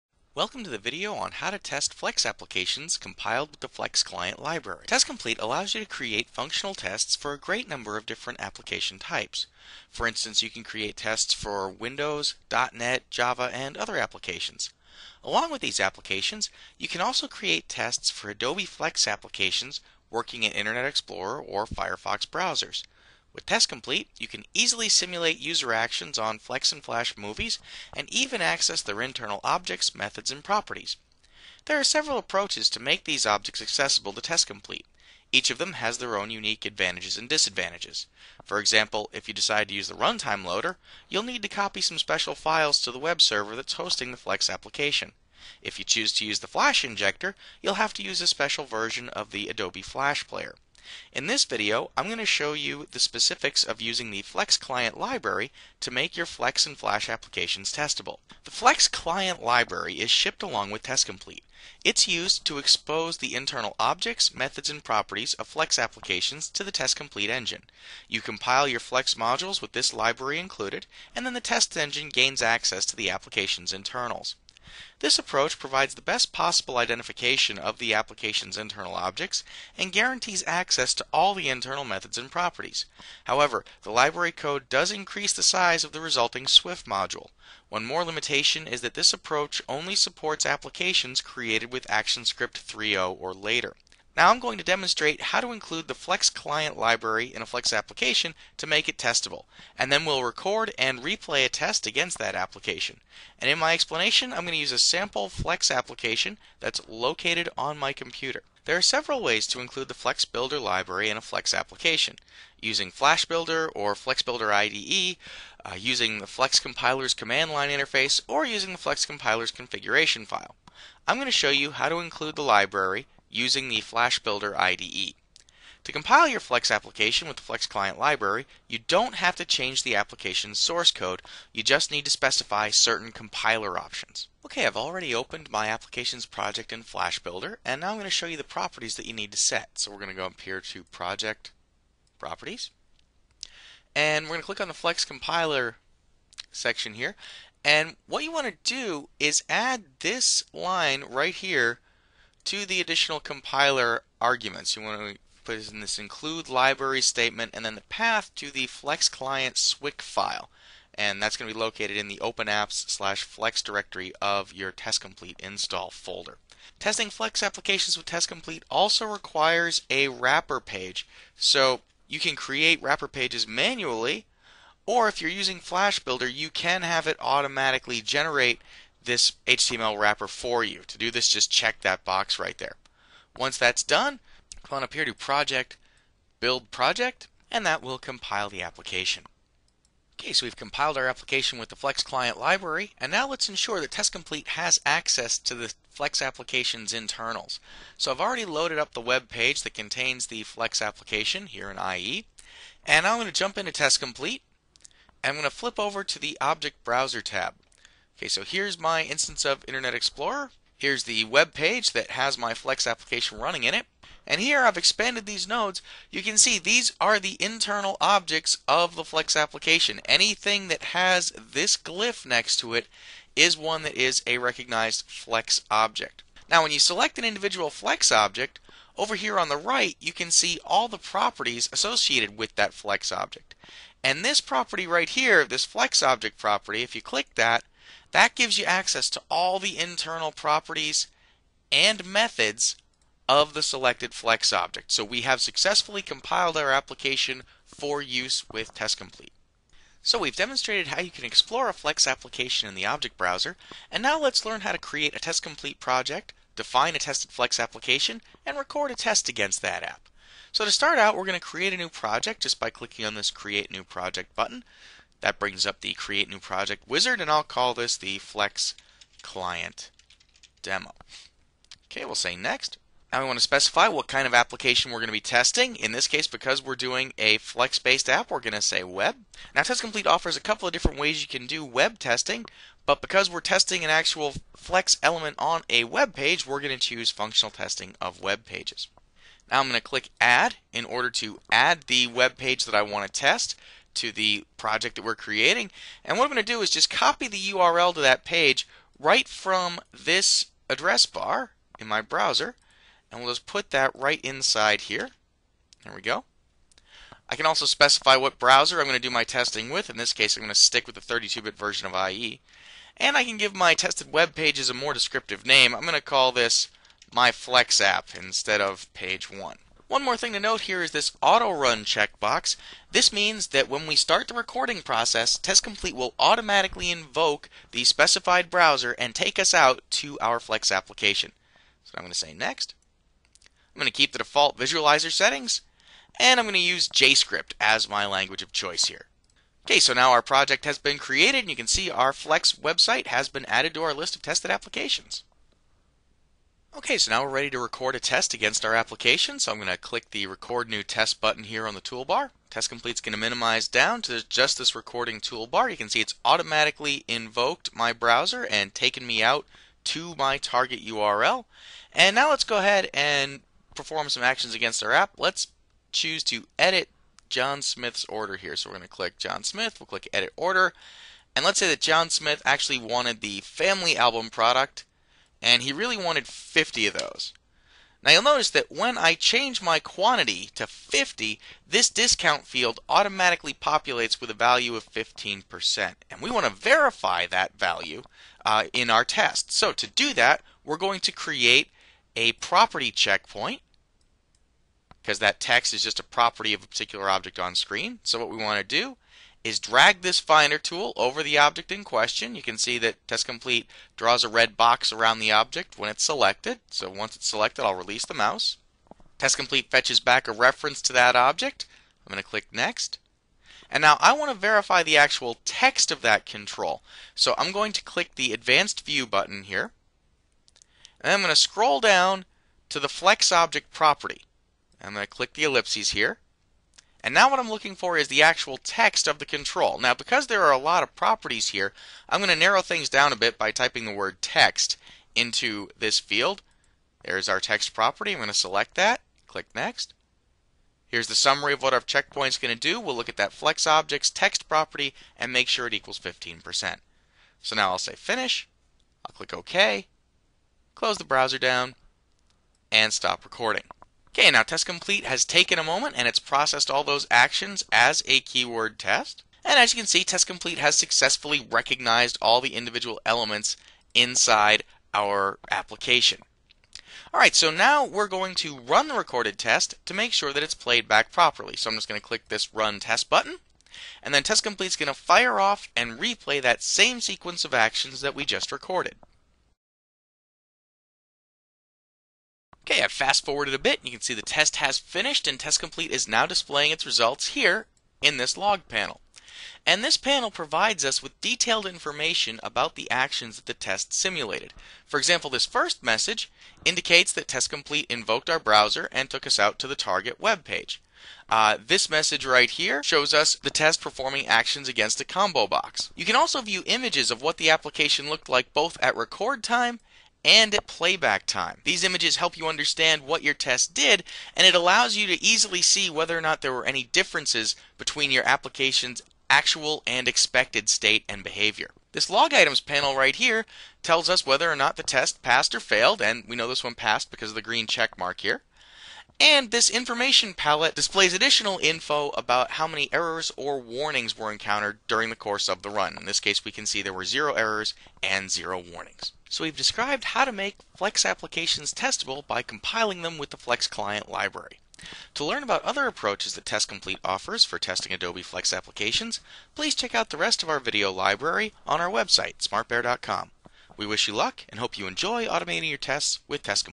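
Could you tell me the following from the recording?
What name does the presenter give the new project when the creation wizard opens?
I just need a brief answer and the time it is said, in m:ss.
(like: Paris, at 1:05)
Flex Client Demo, at 4:28.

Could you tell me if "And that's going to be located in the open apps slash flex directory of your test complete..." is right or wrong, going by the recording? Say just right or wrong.
right.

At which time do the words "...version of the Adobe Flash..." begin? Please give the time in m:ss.
0:48.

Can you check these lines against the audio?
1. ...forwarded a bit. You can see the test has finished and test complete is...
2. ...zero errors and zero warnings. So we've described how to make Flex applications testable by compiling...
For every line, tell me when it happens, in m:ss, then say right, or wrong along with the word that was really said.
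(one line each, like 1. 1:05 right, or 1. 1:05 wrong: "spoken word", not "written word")
1. 8:03 right
2. 8:57 right.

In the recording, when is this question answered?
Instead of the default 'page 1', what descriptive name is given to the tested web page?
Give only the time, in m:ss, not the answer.
5:17.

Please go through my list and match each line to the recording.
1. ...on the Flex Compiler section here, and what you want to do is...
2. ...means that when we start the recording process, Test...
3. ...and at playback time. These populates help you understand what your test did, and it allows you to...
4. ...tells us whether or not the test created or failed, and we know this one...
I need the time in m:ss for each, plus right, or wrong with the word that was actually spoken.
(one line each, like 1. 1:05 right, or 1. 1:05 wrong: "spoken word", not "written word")
1. 2:24 right
2. 5:23 right
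3. 8:30 wrong: "images", not "populates"
4. 8:43 wrong: "passed", not "created".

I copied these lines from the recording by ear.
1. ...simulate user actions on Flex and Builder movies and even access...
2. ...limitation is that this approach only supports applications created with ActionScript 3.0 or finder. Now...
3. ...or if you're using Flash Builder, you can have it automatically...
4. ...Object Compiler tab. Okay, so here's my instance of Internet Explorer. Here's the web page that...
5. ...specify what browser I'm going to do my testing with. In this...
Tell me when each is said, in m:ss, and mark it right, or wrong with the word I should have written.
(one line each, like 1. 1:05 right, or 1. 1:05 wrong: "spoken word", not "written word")
1. 0:24 wrong: "Flash", not "Builder"
2. 1:28 wrong: "later", not "finder"
3. 2:54 right
4. 3:26 wrong: "Browser", not "Compiler"
5. 5:07 right.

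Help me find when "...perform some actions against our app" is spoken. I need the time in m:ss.
6:03.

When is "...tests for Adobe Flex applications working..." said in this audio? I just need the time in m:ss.
0:17.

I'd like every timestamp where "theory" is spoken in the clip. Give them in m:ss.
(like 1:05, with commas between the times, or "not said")
not said.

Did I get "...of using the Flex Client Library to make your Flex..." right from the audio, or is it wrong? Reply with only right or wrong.
right.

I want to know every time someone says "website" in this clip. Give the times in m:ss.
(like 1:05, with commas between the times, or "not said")
5:42, 9:11.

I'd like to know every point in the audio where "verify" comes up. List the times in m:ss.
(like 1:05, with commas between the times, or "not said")
6:26, 6:54.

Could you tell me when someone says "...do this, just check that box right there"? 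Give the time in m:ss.
3:00.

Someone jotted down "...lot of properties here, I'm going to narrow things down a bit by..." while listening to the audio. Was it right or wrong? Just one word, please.
right.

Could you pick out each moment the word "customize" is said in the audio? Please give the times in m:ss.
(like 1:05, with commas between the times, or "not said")
not said.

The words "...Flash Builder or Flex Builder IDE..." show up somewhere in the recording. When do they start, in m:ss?
1:52.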